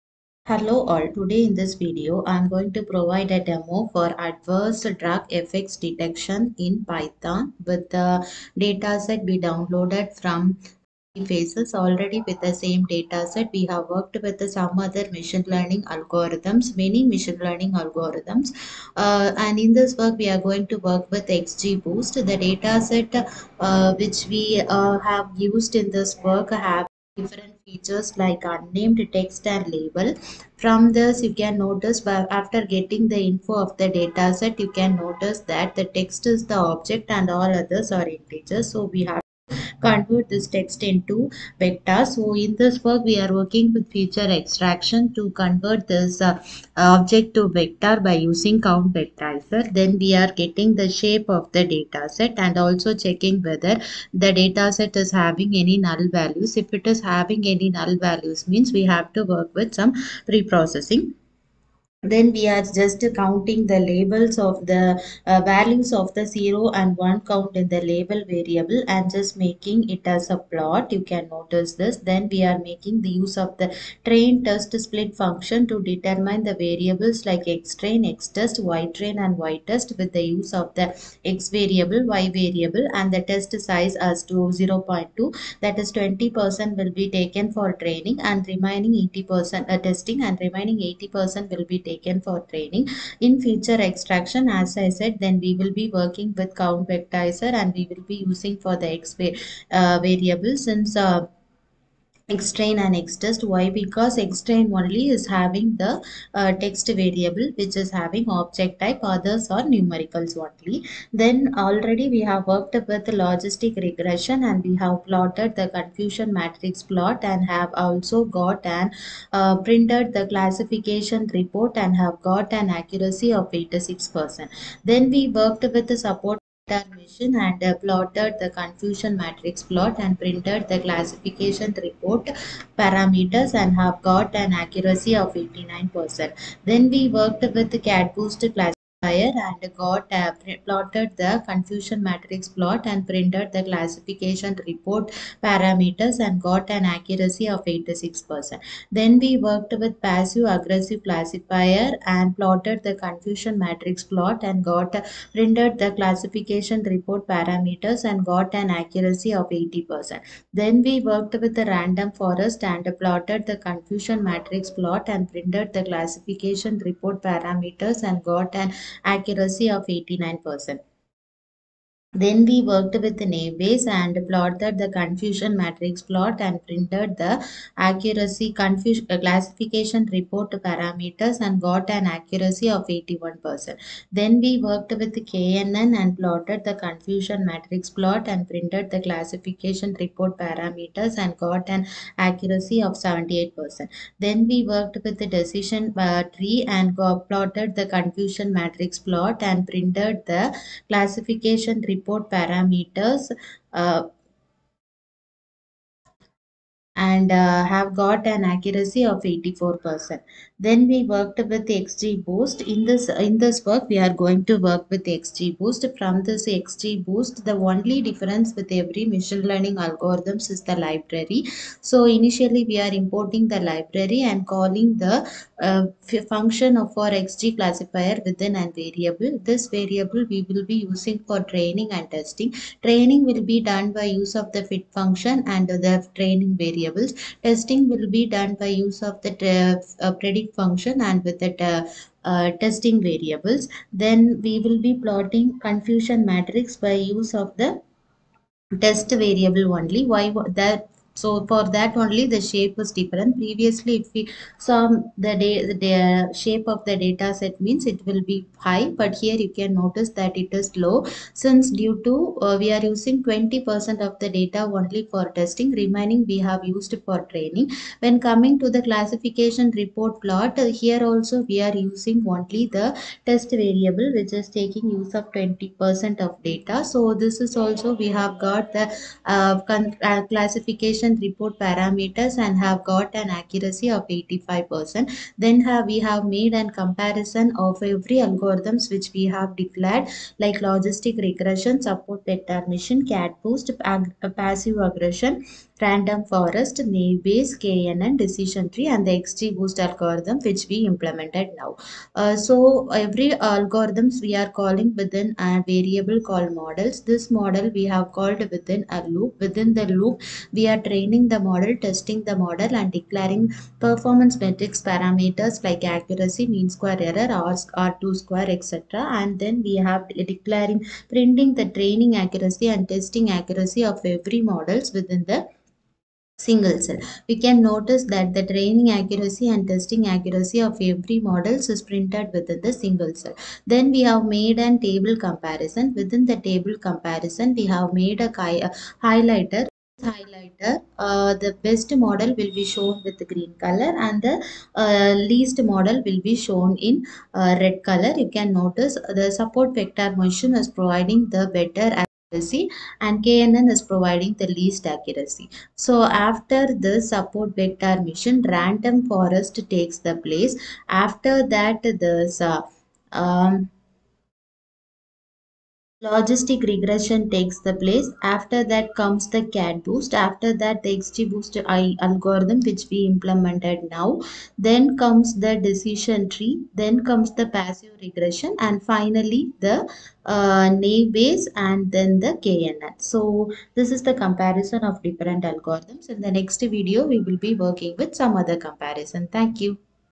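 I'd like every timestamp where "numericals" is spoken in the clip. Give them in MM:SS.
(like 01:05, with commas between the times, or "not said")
01:49.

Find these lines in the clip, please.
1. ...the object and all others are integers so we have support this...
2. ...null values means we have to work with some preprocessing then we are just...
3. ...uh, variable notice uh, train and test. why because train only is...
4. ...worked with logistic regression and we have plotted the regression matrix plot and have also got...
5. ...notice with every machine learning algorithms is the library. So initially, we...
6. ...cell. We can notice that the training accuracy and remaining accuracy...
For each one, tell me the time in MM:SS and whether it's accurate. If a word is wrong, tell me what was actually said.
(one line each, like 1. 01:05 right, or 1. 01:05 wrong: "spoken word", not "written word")
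1. 00:36 wrong: "convert", not "support"
2. 00:57 right
3. 01:39 wrong: "since", not "notice"
4. 01:52 wrong: "confusion", not "regression"
5. 03:38 wrong: "difference", not "notice"
6. 05:26 wrong: "testing", not "remaining".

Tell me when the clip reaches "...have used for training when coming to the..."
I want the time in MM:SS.
04:26.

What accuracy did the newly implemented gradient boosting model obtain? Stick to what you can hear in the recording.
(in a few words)
85%.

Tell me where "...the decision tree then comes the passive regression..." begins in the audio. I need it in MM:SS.
06:15.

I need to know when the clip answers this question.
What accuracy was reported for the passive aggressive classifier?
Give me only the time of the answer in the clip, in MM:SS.
02:38.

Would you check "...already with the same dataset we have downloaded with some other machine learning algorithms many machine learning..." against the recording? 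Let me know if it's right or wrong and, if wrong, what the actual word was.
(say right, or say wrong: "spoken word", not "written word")
wrong: "worked", not "downloaded".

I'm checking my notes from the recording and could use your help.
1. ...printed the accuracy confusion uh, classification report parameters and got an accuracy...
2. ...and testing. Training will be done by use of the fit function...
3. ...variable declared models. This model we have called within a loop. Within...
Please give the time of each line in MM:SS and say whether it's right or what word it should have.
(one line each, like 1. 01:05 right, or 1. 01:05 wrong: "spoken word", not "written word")
1. 02:56 right
2. 03:51 right
3. 05:05 wrong: "called", not "declared".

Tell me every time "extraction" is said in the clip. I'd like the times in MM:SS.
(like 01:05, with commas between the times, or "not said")
00:44, 01:33.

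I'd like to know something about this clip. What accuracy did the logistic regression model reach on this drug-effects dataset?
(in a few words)
86%.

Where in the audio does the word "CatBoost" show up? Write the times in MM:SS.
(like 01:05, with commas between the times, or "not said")
02:17, 06:09.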